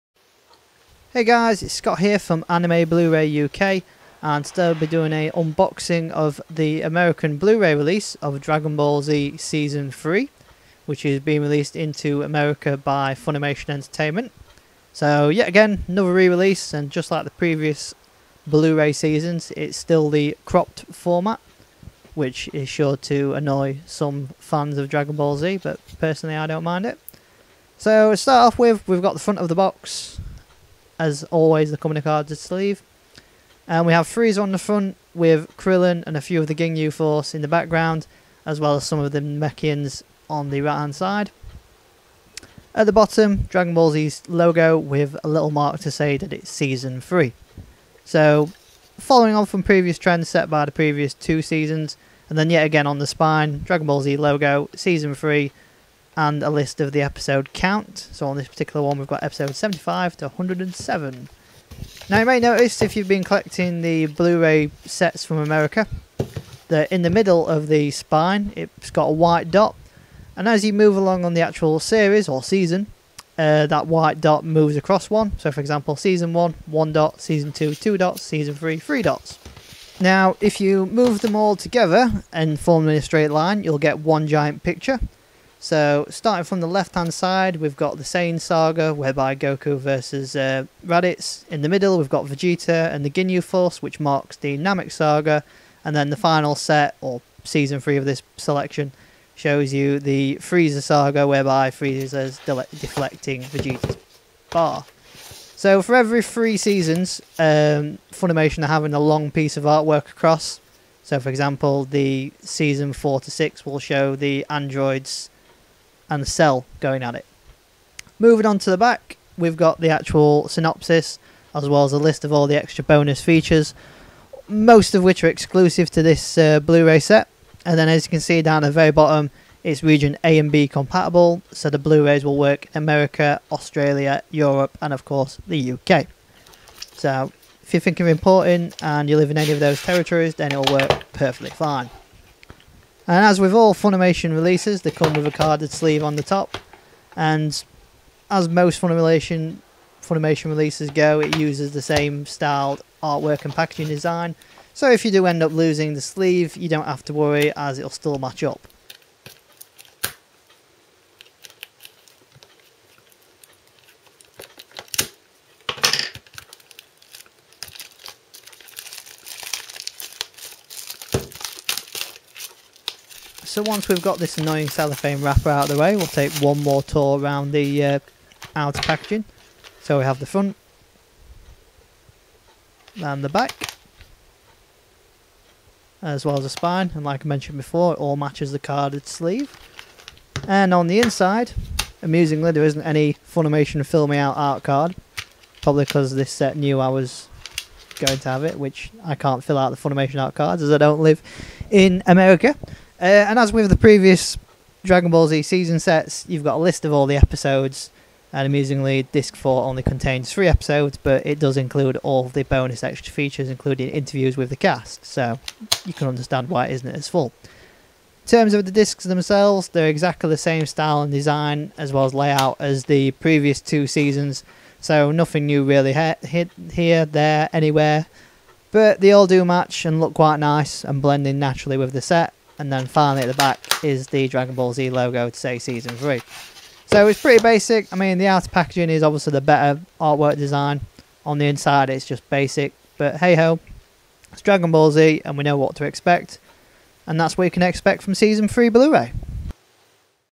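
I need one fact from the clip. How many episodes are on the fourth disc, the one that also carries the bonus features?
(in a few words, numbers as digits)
3.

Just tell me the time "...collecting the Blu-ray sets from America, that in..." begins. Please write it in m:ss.
1:03.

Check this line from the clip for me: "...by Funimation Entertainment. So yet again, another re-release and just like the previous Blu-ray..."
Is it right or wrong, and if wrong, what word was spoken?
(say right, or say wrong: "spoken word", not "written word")
right.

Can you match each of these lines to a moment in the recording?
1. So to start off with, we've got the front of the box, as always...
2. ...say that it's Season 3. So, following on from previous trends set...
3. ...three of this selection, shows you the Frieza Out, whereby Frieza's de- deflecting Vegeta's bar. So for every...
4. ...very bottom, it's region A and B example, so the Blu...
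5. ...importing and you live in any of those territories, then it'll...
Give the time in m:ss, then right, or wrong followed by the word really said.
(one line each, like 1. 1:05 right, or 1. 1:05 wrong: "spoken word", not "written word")
1. 0:27 right
2. 0:45 right
3. 1:37 wrong: "Saga", not "Out"
4. 2:08 wrong: "compatible", not "example"
5. 2:18 right.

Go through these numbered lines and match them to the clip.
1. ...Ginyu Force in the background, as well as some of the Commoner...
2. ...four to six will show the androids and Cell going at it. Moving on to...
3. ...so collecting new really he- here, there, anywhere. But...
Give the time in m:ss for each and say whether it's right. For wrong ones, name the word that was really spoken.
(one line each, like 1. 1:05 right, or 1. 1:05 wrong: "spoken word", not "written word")
1. 0:36 wrong: "Namekians", not "Commoner"
2. 1:52 right
3. 3:44 wrong: "nothing", not "collecting".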